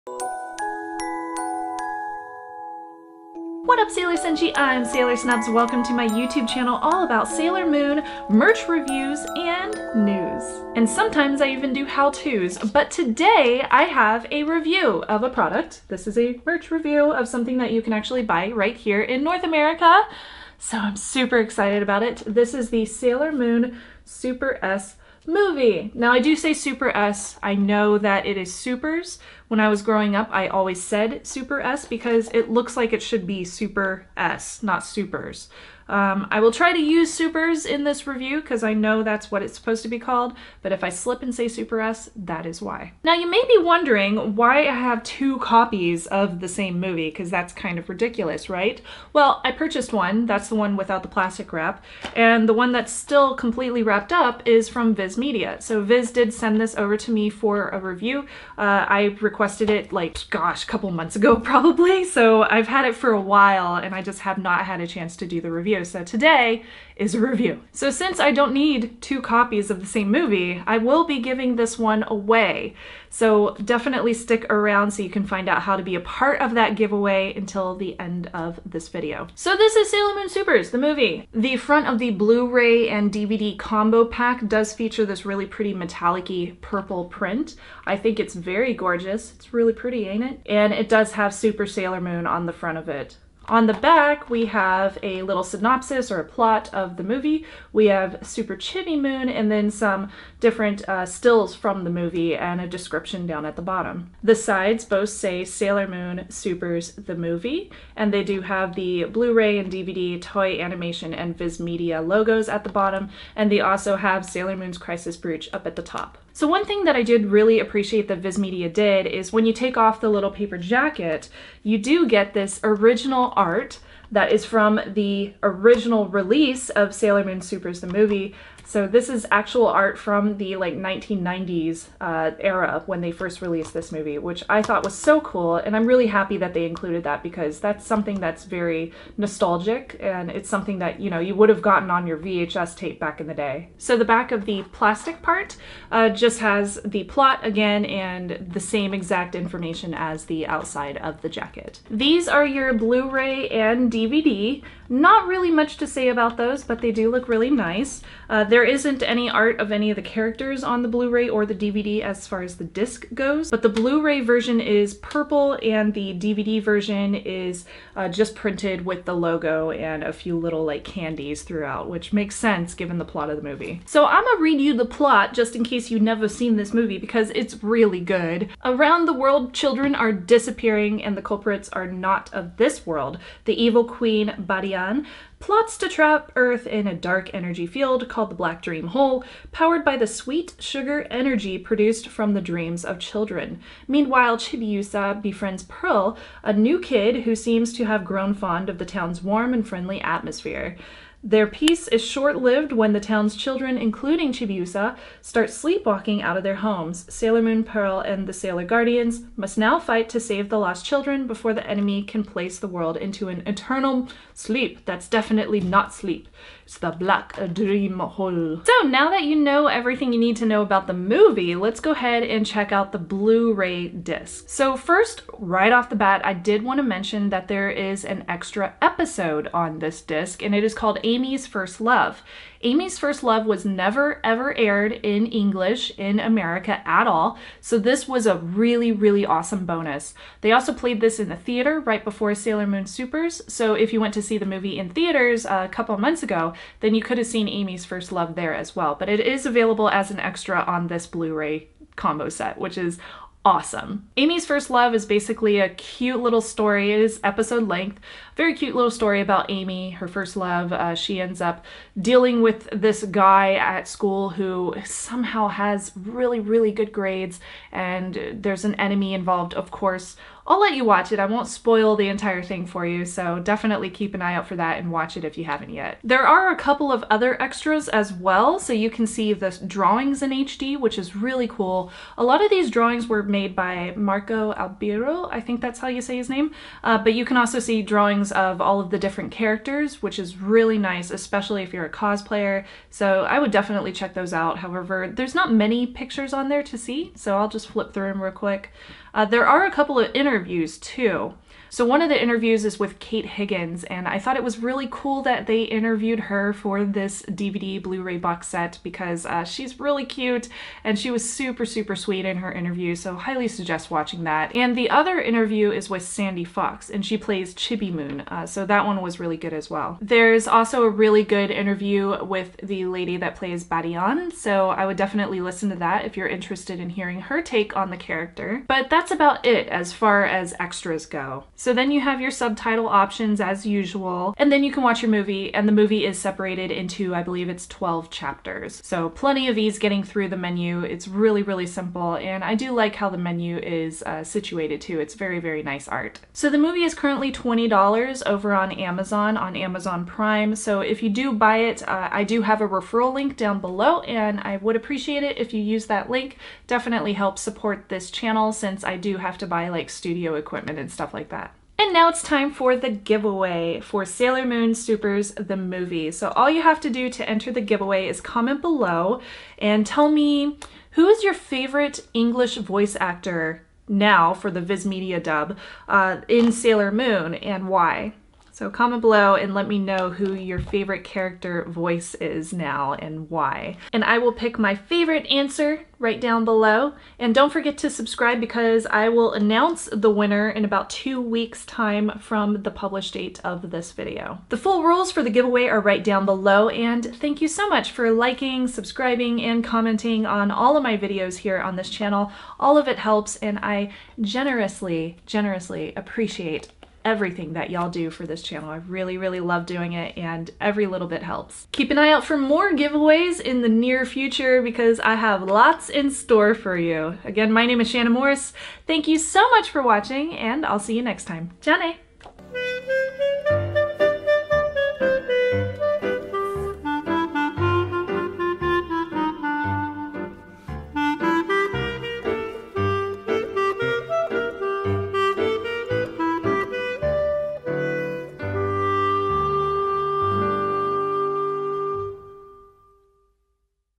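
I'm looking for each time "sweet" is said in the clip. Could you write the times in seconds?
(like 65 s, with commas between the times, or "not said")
190 s, 311 s.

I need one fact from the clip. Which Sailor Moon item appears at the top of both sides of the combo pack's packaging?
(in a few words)
Crisis Brooch.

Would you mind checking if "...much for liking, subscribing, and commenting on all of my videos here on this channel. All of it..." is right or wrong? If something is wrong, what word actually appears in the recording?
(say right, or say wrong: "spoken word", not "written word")
right.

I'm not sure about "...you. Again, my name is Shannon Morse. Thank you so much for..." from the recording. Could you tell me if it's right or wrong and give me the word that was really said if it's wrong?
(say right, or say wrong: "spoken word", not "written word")
right.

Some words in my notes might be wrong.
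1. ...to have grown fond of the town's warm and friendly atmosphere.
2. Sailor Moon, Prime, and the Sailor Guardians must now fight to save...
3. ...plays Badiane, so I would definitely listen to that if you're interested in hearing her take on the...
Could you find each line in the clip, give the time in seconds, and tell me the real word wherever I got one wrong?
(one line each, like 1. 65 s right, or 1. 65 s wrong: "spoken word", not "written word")
1. 197 s right
2. 207 s wrong: "Pearl", not "Prime"
3. 323 s right.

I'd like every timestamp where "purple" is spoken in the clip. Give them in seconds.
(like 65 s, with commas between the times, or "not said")
86 s, 164 s.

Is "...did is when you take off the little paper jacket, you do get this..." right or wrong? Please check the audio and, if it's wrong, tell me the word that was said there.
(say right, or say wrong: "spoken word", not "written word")
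right.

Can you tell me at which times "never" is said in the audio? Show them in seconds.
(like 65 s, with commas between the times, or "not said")
176 s, 233 s.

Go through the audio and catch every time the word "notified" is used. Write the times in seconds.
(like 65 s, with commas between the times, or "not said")
not said.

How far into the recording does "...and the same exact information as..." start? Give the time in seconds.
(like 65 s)
147 s.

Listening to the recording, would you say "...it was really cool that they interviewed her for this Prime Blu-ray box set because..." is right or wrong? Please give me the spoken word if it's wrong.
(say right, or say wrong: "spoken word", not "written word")
wrong: "DVD", not "Prime".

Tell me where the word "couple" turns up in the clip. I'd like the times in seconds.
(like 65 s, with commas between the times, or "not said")
60 s, 245 s, 276 s, 299 s.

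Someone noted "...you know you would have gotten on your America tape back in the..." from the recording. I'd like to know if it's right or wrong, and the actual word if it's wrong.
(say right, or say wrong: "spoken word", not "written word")
wrong: "VHS", not "America".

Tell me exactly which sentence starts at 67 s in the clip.
So since I don't need two copies of the same movie, I will be giving this one away.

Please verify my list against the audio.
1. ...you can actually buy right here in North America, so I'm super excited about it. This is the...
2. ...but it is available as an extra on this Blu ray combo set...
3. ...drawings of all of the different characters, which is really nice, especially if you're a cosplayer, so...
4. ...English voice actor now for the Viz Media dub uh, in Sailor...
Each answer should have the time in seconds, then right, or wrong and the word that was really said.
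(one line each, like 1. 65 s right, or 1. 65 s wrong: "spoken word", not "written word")
1. 17 s right
2. 248 s right
3. 287 s right
4. 372 s right.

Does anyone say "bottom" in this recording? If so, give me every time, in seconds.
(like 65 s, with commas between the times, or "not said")
103 s, 112 s.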